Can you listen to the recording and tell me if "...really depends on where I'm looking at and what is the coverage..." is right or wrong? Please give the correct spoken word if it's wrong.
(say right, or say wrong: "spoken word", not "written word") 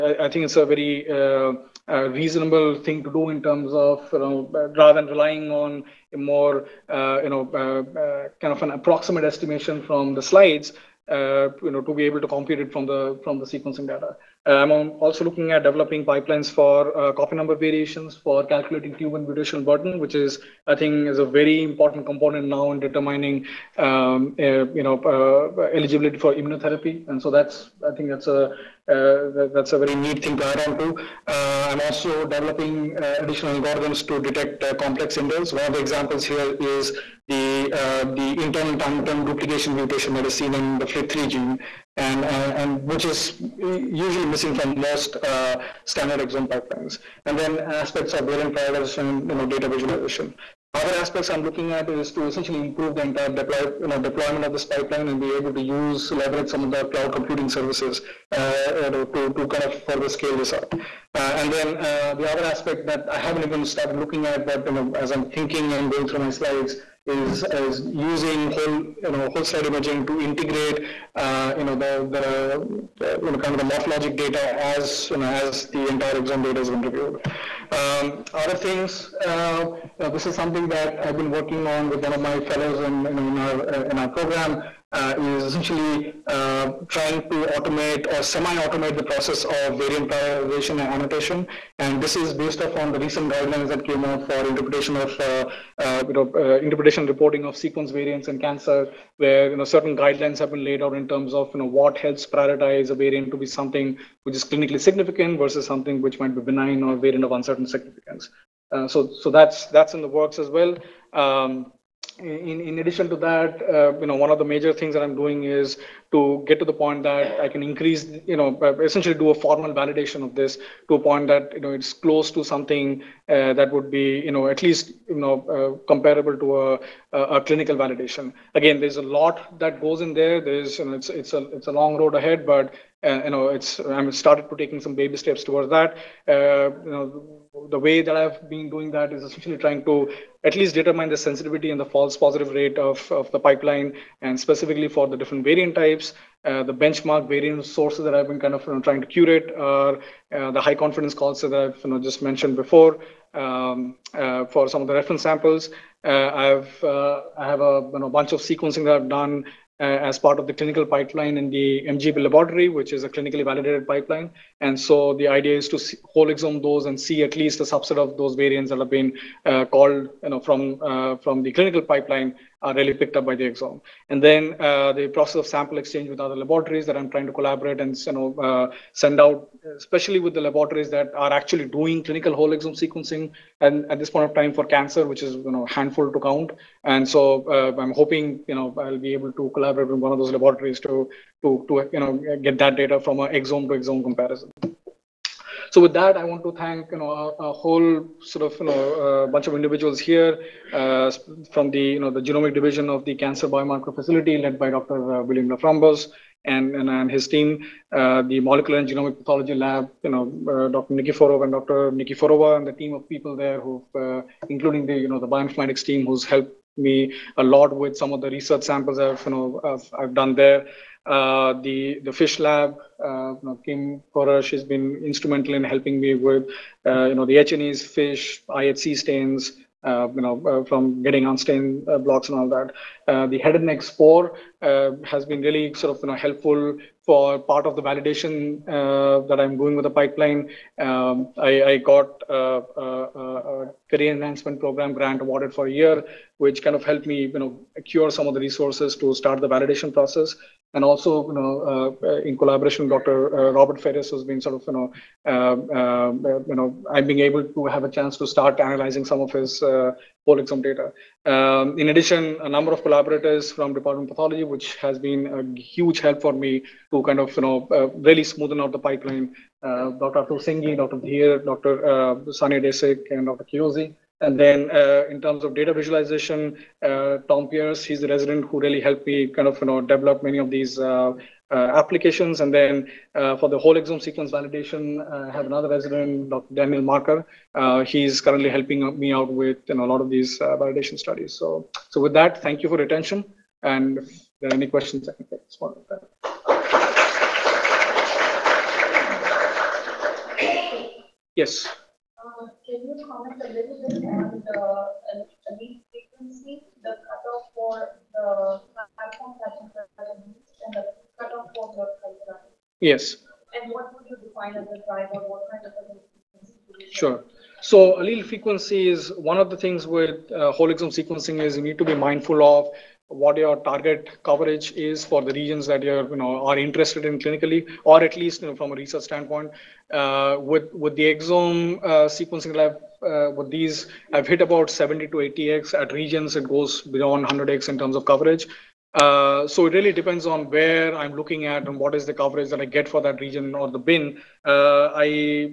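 right.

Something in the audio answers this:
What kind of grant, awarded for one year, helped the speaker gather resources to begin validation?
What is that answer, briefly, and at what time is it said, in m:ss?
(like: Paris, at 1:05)
Career enhancement program grant, at 4:03.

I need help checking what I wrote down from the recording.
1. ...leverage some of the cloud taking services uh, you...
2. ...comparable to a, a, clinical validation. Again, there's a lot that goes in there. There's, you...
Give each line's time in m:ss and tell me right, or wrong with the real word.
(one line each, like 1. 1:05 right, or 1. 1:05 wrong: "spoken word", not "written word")
1. 0:56 wrong: "computing", not "taking"
2. 2:05 right.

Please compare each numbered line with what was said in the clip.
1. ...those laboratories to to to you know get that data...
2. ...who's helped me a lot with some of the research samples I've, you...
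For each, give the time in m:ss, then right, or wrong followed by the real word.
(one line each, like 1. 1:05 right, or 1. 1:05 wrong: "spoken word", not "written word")
1. 3:10 right
2. 3:36 right.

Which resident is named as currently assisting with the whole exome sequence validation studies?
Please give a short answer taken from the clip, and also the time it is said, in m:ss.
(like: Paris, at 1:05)
Daniel Marker, at 4:46.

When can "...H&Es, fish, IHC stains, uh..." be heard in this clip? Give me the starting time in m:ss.
3:47.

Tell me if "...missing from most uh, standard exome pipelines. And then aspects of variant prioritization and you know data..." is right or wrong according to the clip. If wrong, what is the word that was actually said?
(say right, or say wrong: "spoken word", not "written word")
right.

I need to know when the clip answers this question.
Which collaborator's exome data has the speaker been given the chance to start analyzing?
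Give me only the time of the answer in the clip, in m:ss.
4:13.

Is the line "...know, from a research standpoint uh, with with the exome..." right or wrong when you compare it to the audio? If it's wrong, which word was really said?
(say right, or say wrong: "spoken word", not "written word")
right.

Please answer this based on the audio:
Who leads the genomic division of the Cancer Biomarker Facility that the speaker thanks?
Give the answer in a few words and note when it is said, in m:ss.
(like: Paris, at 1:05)
William LaFramboise, at 3:25.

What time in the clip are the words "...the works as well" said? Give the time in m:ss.
1:50.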